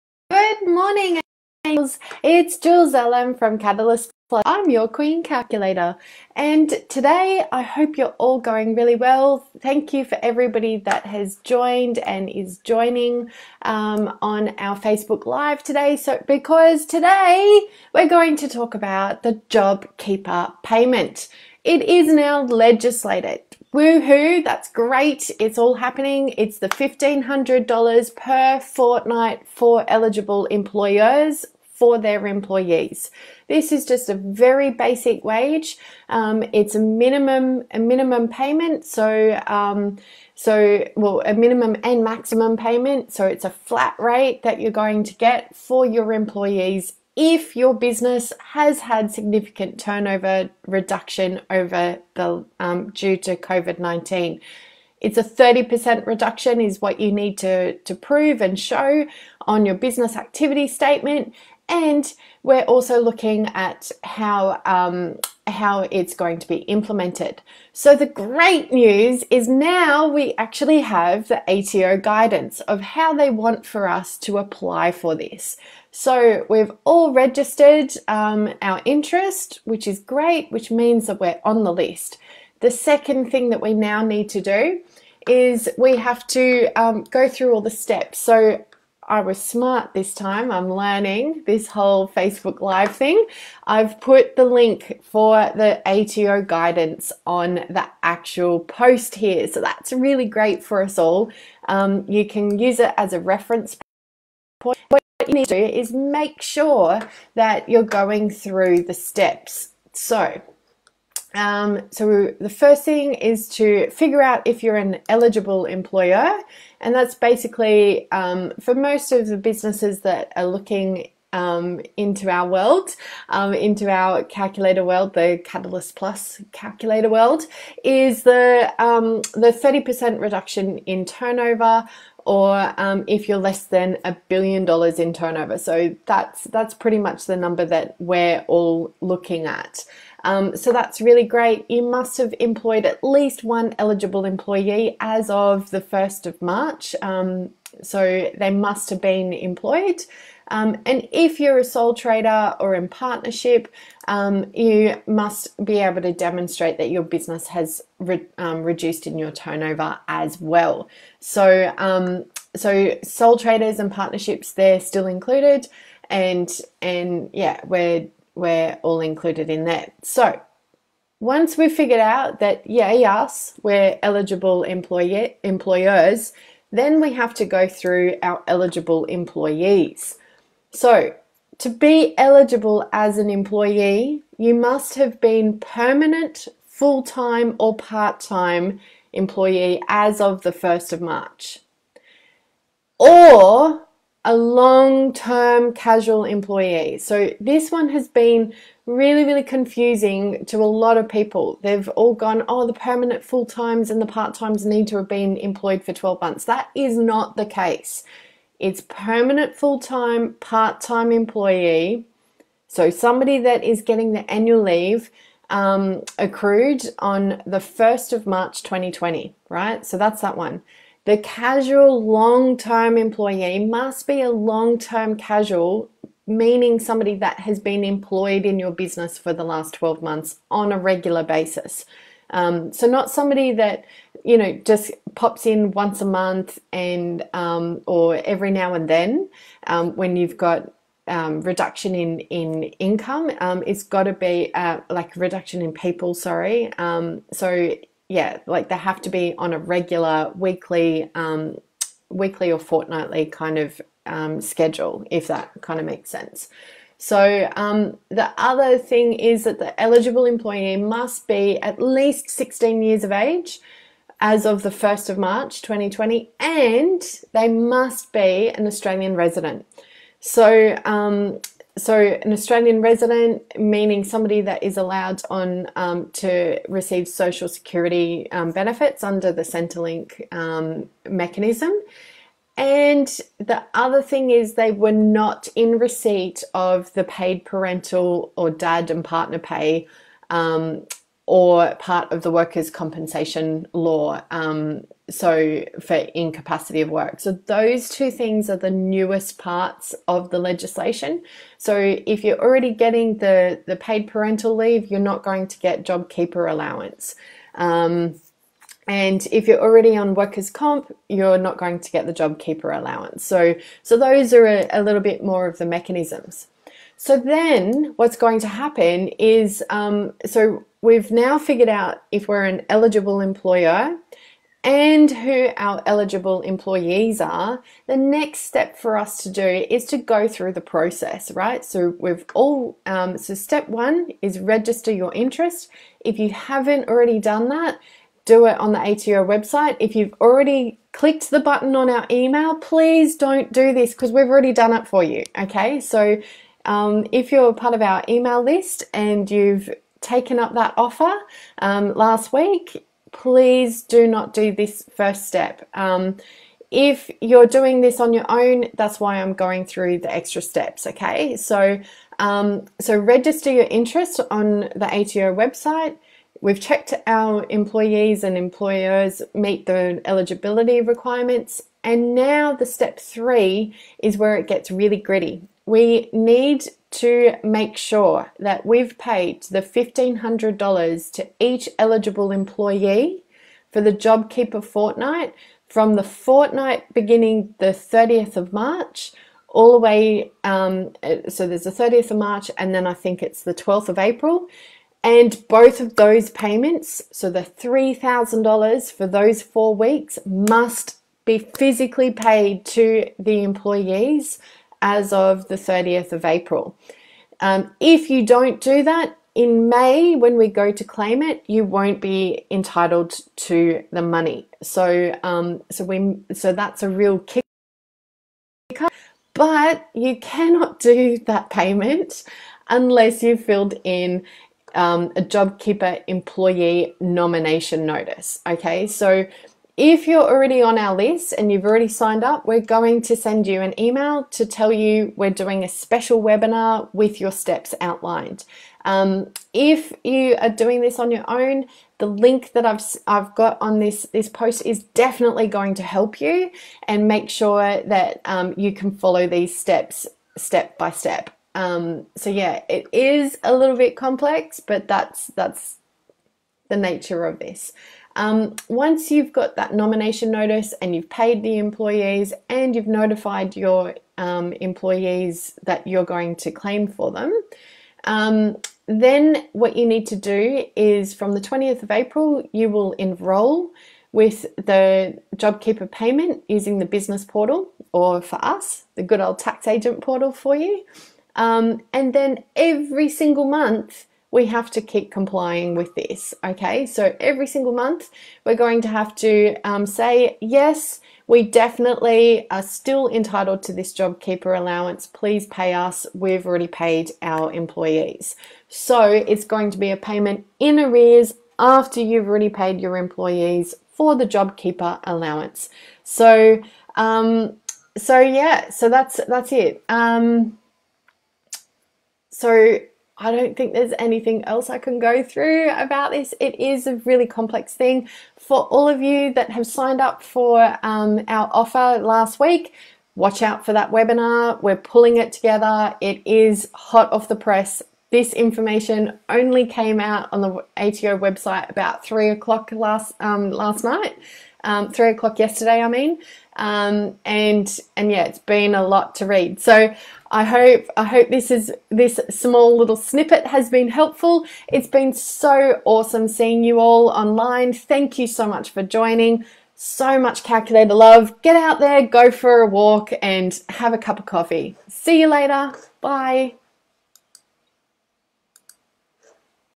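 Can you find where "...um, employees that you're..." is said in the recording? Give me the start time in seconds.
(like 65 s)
464 s.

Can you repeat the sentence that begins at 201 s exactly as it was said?
They've all gone, oh, the permanent full times and the part times need to have been employed for 12 months.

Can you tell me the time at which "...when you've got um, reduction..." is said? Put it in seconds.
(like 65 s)
239 s.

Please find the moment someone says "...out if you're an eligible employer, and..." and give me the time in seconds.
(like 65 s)
114 s.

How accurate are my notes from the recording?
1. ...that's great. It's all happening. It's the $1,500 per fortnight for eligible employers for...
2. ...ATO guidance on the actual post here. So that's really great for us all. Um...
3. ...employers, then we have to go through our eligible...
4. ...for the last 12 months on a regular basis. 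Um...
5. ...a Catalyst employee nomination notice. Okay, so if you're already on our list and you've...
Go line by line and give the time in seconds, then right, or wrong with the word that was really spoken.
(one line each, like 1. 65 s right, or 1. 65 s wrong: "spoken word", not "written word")
1. 24 s right
2. 95 s right
3. 174 s right
4. 229 s right
5. 425 s wrong: "JobKeeper", not "Catalyst".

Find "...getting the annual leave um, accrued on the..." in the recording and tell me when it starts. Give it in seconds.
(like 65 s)
213 s.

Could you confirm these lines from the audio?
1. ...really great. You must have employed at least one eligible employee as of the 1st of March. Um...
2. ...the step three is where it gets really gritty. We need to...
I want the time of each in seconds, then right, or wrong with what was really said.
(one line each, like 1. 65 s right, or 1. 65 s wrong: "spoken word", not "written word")
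1. 141 s right
2. 372 s right.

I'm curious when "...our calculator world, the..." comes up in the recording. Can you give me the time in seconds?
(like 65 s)
123 s.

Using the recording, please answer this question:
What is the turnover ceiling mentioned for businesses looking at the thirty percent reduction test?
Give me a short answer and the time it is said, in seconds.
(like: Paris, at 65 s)
a billion dollars, at 134 s.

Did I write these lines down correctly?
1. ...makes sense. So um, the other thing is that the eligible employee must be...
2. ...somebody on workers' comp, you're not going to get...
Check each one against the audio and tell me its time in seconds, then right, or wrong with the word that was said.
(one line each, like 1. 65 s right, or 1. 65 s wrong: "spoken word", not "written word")
1. 255 s right
2. 309 s wrong: "already", not "somebody".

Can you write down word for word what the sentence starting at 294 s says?
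Um, so, for incapacity of work.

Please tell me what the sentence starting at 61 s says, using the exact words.
And we're also looking at how um, how it's going to be implemented.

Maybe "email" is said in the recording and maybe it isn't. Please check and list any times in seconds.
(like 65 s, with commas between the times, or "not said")
342 s, 348 s, 433 s.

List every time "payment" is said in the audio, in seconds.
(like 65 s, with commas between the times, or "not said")
20 s, 38 s, 42 s, 396 s, 421 s, 475 s, 499 s.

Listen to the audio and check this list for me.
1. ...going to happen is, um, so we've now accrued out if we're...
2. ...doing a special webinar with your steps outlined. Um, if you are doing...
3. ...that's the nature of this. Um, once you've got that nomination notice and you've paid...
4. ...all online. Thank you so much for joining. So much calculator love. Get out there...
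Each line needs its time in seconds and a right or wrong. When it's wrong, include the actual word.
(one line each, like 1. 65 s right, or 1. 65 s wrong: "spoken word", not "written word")
1. 318 s wrong: "figured", not "accrued"
2. 435 s right
3. 455 s right
4. 546 s right.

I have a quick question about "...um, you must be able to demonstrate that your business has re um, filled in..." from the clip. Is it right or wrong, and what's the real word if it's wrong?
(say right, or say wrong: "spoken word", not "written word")
wrong: "reduced", not "filled".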